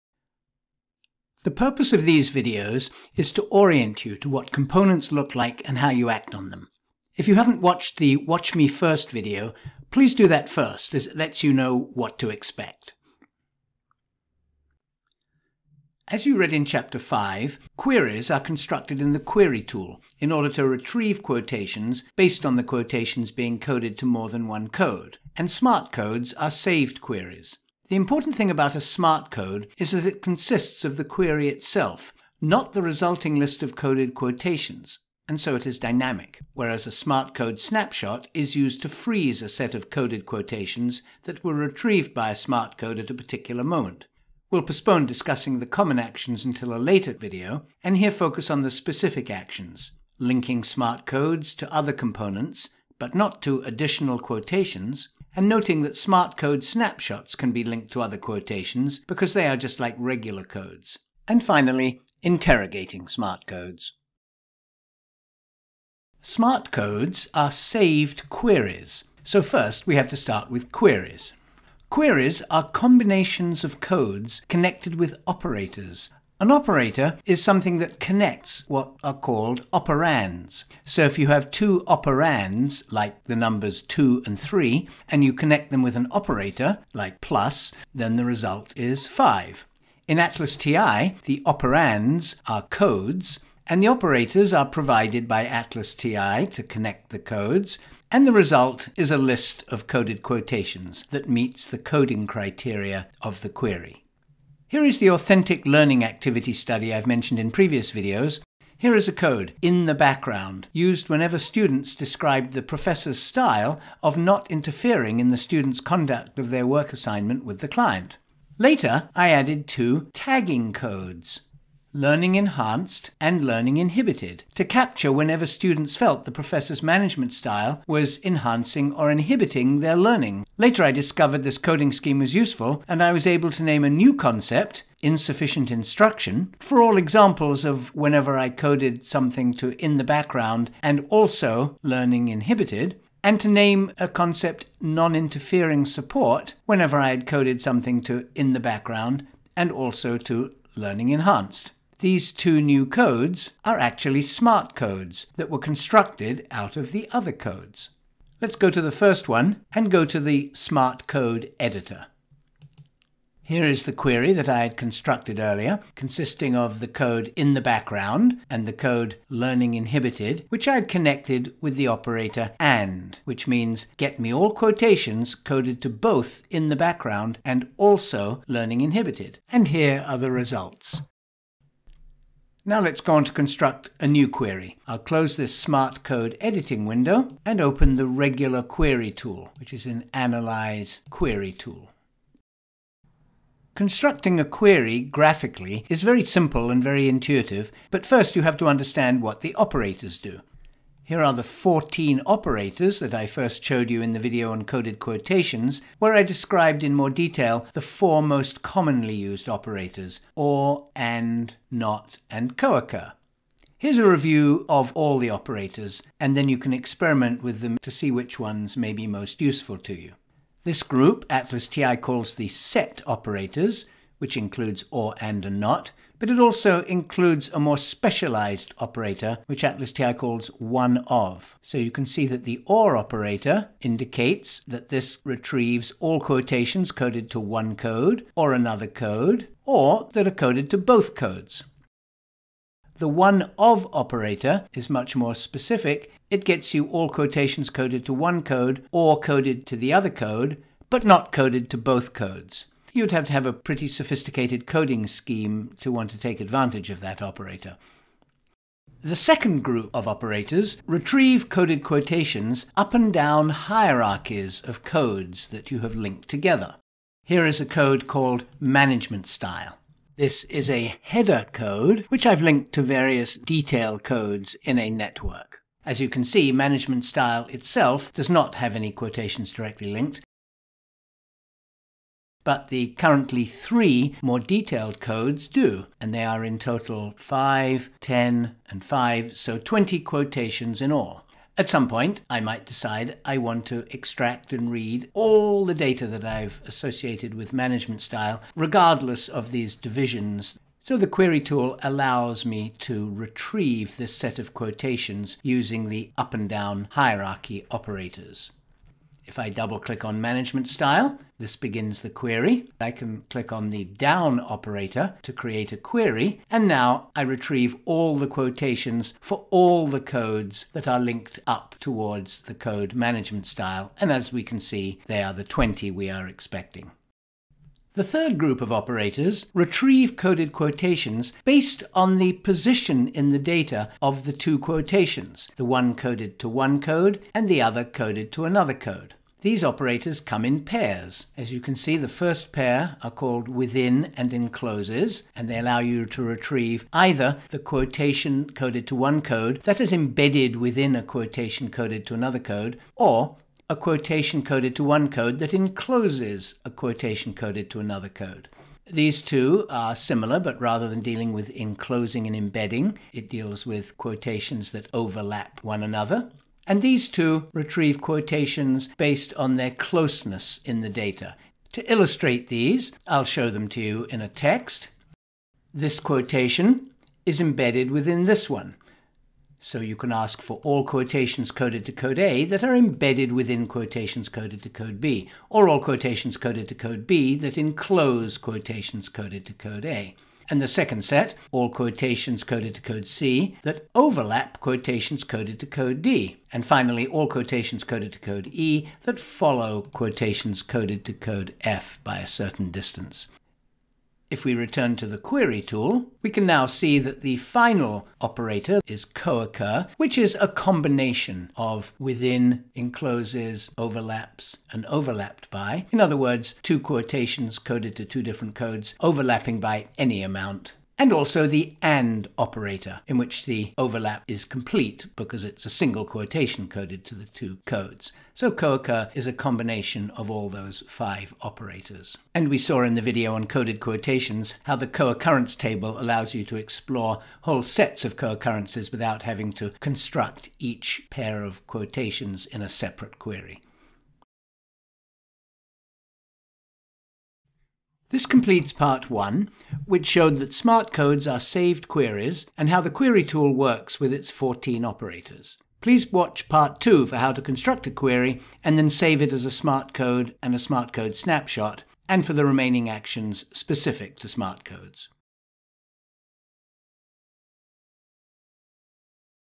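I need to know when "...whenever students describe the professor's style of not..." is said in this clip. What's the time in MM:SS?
01:51.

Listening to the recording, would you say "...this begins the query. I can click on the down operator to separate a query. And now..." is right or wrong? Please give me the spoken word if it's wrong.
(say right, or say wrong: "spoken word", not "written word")
wrong: "create", not "separate".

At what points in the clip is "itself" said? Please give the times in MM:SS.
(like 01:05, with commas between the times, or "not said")
00:31, 04:37.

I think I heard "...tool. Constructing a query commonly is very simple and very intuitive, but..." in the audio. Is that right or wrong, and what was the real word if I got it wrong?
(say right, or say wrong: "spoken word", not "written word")
wrong: "graphically", not "commonly".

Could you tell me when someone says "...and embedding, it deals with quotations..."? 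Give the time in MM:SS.
06:02.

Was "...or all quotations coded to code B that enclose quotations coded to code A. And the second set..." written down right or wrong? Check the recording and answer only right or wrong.
right.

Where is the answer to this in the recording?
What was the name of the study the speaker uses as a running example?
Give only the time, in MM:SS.
01:45.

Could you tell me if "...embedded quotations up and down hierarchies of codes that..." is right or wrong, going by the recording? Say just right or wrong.
wrong.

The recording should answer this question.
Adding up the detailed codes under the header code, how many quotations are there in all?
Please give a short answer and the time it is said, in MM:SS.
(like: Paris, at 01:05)
20, at 04:49.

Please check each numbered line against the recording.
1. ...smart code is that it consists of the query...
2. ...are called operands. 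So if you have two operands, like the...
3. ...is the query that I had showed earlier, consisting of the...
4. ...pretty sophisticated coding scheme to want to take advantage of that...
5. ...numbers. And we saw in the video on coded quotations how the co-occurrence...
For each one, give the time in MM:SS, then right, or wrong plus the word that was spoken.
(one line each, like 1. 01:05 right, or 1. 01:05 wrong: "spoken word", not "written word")
1. 00:28 right
2. 01:19 right
3. 02:43 wrong: "constructed", not "showed"
4. 04:13 right
5. 07:11 wrong: "operators", not "numbers".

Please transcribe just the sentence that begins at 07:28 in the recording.
This completes part one, which showed that smart codes are saved queries and how the query tool works with its 14 operators.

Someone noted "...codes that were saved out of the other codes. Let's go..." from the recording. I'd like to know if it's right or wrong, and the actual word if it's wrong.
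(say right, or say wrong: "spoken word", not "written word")
wrong: "constructed", not "saved".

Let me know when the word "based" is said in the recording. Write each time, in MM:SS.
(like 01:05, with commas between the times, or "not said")
00:22, 05:31, 06:08.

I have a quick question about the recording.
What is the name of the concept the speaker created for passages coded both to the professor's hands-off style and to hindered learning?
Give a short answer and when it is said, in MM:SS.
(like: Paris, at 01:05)
insufficient instruction, at 02:15.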